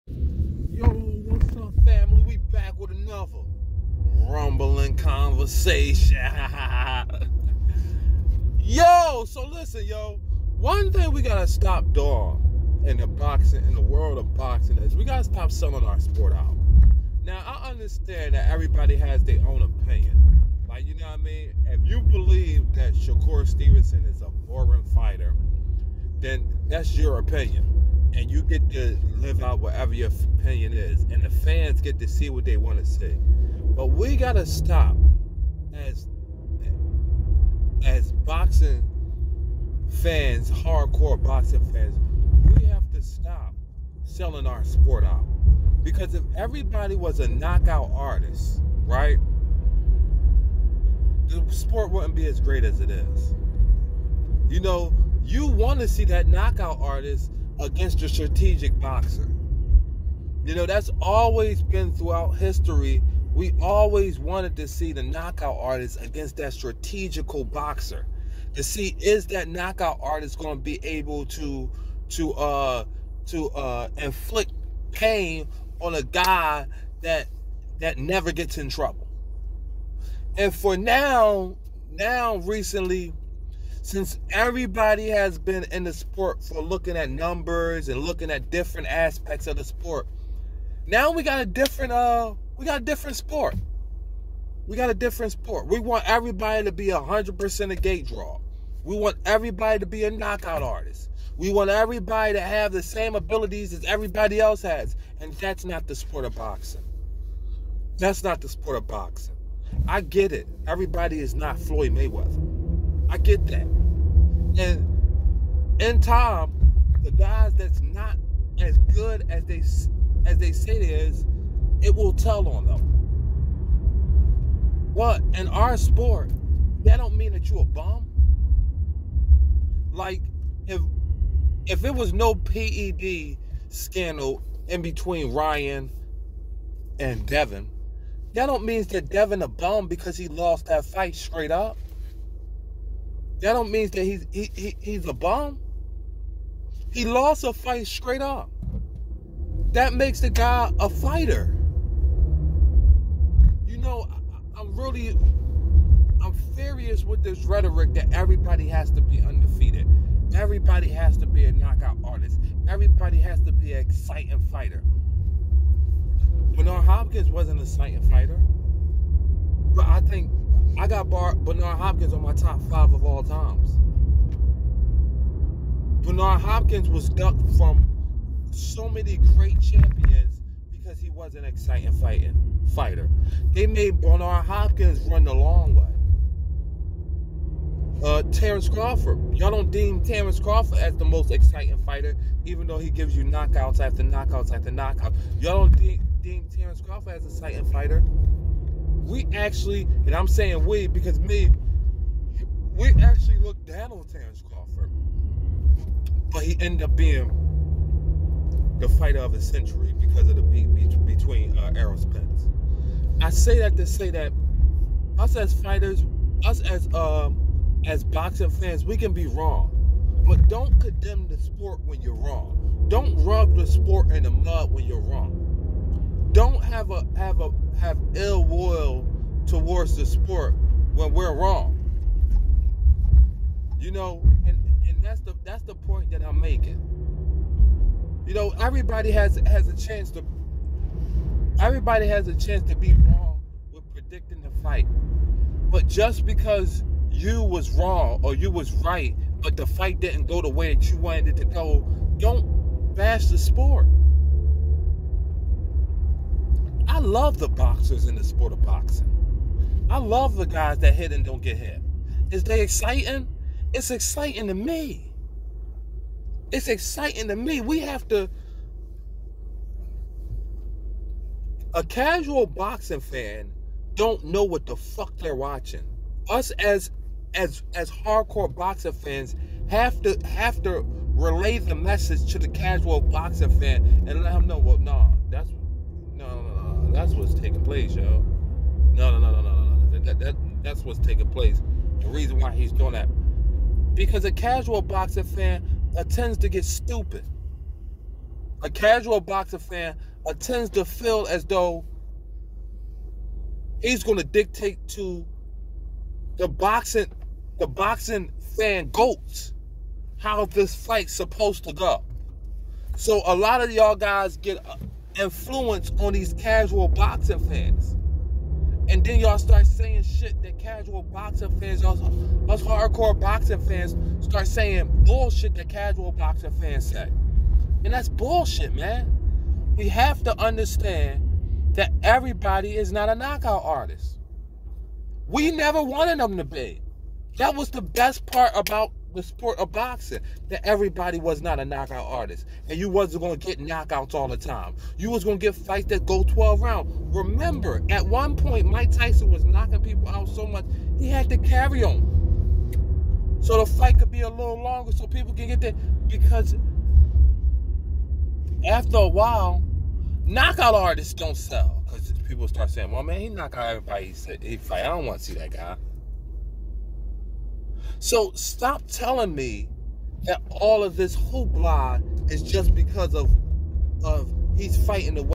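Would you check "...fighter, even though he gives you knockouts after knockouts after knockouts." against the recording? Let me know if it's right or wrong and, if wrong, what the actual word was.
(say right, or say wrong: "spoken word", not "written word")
right.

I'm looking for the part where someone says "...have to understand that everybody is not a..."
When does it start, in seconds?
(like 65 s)
329 s.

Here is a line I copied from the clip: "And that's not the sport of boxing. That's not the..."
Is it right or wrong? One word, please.
right.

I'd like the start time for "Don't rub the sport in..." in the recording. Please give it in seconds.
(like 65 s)
222 s.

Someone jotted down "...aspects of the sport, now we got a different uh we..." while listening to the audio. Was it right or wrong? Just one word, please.
right.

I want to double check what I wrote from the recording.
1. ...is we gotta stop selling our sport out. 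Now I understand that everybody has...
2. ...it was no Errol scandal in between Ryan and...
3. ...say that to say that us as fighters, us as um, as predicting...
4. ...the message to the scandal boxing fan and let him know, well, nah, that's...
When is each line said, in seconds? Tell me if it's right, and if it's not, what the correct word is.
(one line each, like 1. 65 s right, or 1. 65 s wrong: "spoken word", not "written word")
1. 14 s right
2. 131 s wrong: "PED", not "Errol"
3. 213 s wrong: "boxing", not "predicting"
4. 281 s wrong: "casual", not "scandal".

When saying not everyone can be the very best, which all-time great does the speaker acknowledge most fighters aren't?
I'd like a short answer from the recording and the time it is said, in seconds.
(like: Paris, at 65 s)
Floyd Mayweather, at 111 s.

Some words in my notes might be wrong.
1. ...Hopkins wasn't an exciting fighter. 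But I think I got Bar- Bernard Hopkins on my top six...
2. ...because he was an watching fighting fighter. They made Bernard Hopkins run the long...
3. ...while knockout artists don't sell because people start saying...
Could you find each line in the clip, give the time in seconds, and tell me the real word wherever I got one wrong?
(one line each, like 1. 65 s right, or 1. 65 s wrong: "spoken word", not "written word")
1. 166 s wrong: "five", not "six"
2. 180 s wrong: "exciting", not "watching"
3. 359 s right.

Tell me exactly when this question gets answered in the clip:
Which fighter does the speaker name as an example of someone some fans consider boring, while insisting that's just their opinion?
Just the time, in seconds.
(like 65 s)
22 s.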